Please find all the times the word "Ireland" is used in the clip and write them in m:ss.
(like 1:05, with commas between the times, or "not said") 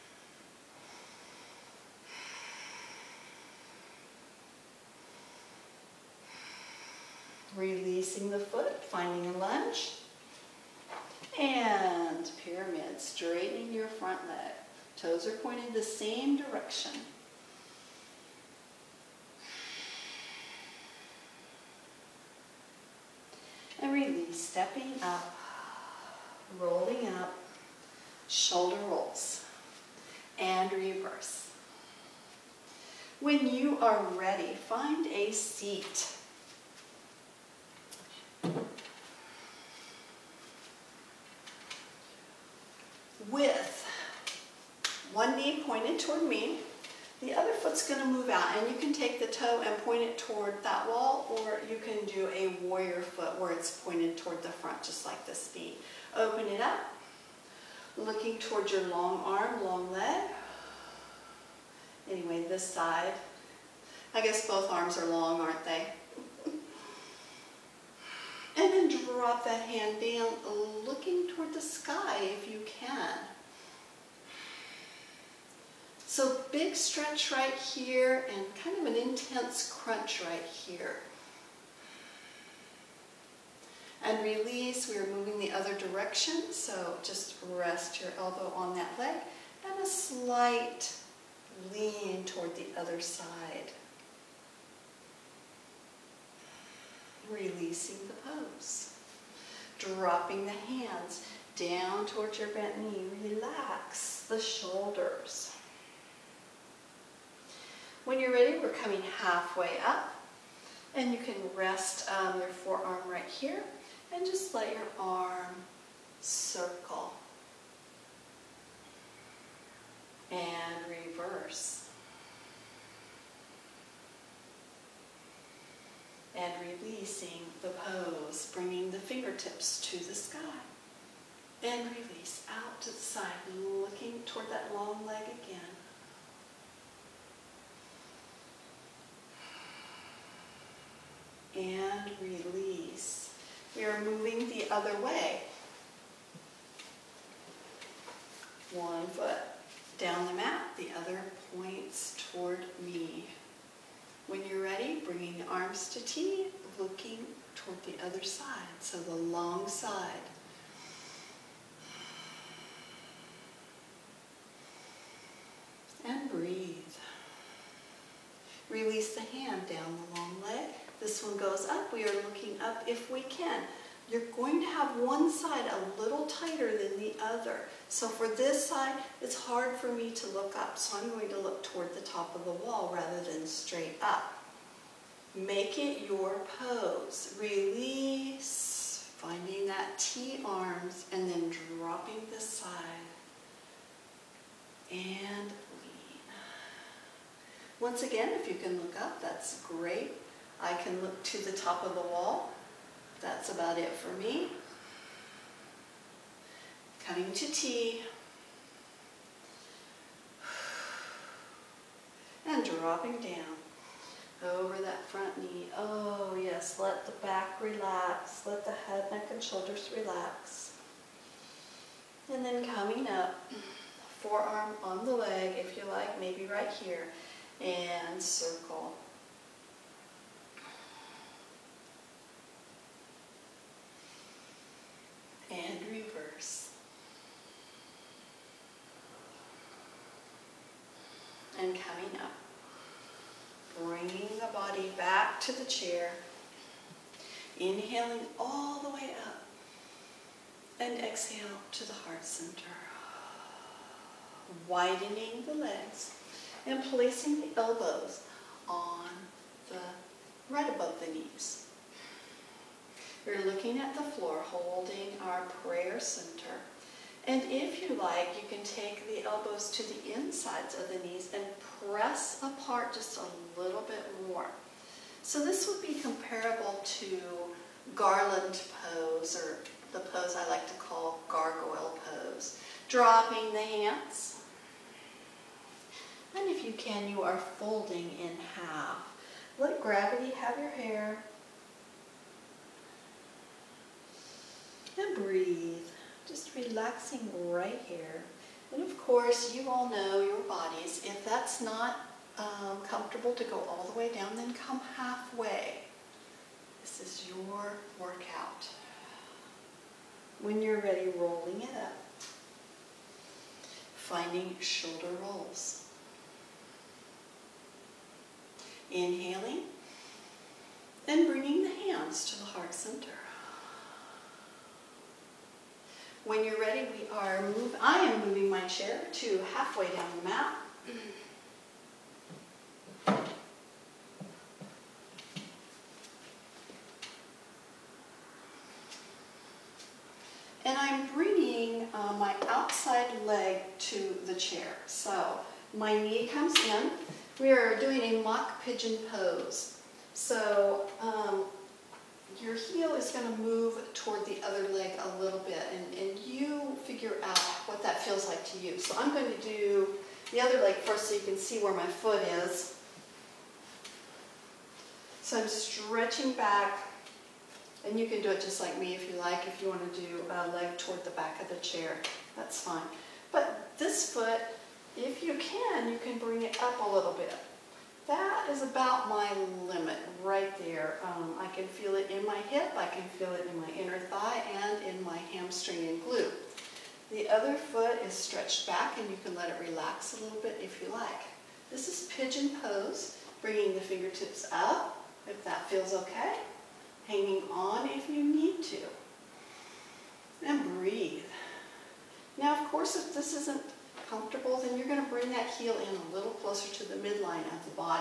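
not said.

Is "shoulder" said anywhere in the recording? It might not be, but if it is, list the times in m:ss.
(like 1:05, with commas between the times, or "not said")
0:28, 1:44, 3:39, 5:14.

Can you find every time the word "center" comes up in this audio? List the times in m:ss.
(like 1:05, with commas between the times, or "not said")
4:12, 4:25, 5:22.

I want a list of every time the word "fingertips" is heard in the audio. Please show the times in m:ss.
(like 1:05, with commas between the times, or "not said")
2:08, 6:33.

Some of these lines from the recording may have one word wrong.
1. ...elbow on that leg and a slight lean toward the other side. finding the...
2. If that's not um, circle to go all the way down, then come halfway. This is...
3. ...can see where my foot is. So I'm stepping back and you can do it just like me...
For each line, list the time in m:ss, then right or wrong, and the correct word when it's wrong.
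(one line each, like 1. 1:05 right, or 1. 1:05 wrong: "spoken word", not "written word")
1. 1:28 wrong: "releasing", not "finding"
2. 5:01 wrong: "comfortable", not "circle"
3. 6:01 wrong: "stretching", not "stepping".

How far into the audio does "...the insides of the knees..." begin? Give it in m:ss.
4:29.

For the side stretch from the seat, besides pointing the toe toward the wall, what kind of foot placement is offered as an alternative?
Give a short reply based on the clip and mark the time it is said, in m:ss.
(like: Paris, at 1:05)
Warrior foot, at 0:52.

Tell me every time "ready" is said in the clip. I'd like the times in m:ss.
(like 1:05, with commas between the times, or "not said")
0:34, 1:48, 5:10, 5:26.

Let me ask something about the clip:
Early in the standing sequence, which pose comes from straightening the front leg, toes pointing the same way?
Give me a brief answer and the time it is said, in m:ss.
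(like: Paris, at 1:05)
Pyramid, at 0:12.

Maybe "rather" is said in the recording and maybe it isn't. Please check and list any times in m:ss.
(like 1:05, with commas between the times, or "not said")
3:02.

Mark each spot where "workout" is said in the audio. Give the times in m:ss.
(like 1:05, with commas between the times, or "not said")
5:07.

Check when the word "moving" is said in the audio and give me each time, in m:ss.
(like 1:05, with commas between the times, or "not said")
1:25, 2:24, 5:28.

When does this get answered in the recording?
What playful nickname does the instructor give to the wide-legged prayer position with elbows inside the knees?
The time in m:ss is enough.
4:41.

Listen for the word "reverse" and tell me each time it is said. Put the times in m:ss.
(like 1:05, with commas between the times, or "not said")
0:30, 2:00.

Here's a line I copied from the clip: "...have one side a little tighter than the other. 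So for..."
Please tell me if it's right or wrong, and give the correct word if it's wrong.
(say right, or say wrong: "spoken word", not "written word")
right.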